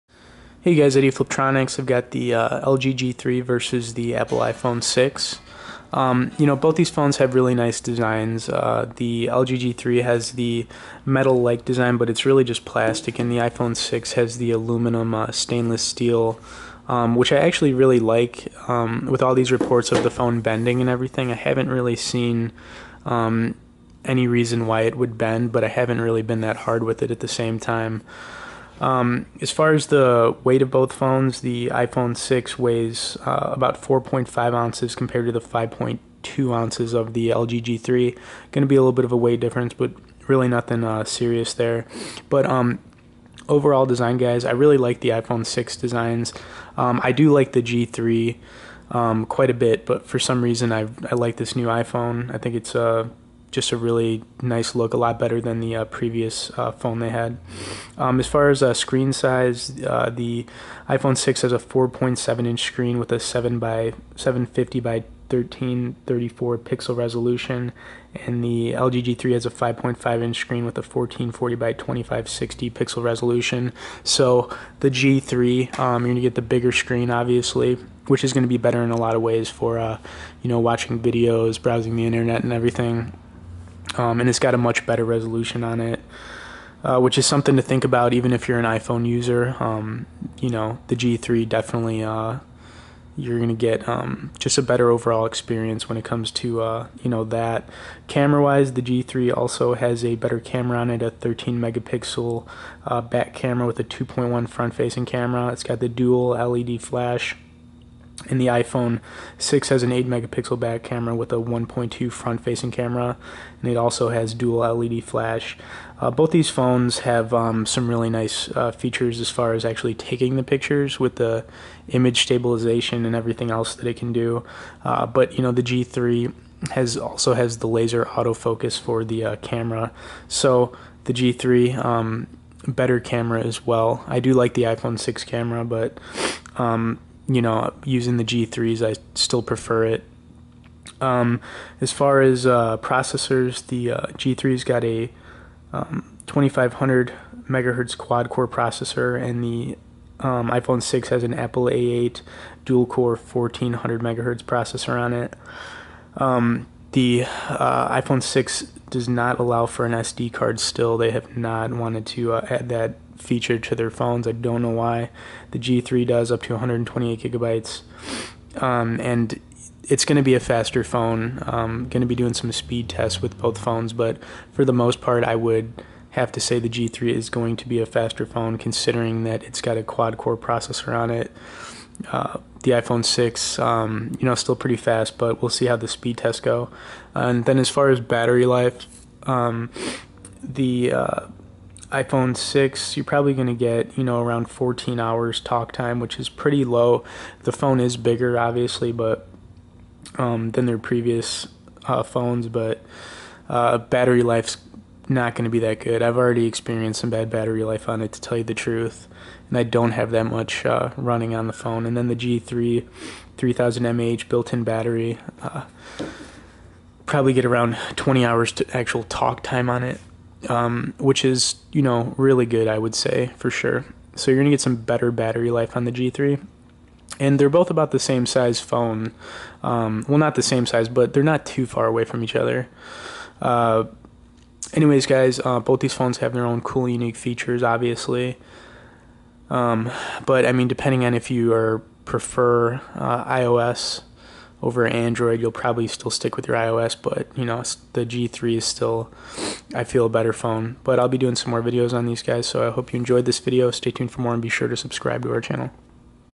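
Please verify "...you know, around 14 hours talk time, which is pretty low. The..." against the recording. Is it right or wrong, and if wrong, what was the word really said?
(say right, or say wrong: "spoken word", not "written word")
right.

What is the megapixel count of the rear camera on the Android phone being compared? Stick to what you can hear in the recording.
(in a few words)
13 megapixel.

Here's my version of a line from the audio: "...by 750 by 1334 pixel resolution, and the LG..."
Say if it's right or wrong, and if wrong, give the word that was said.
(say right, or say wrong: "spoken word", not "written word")
right.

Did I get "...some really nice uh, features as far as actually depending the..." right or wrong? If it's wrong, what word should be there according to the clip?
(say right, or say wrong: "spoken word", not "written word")
wrong: "taking", not "depending".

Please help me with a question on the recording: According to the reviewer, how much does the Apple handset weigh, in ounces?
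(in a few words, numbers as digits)
4.5 ounces.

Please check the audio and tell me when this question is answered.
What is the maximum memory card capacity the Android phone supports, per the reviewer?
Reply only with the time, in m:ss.
2:46.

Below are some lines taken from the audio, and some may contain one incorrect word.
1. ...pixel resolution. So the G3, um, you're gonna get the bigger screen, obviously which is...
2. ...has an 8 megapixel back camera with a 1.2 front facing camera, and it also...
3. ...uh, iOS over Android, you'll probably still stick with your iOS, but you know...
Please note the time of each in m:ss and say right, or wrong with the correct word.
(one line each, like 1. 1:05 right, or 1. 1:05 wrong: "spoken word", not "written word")
1. 1:12 right
2. 1:49 right
3. 4:02 right.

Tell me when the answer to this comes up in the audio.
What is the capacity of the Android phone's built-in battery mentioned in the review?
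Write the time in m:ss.
3:33.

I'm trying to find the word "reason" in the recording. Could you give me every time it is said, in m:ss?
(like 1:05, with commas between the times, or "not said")
0:24, 0:50.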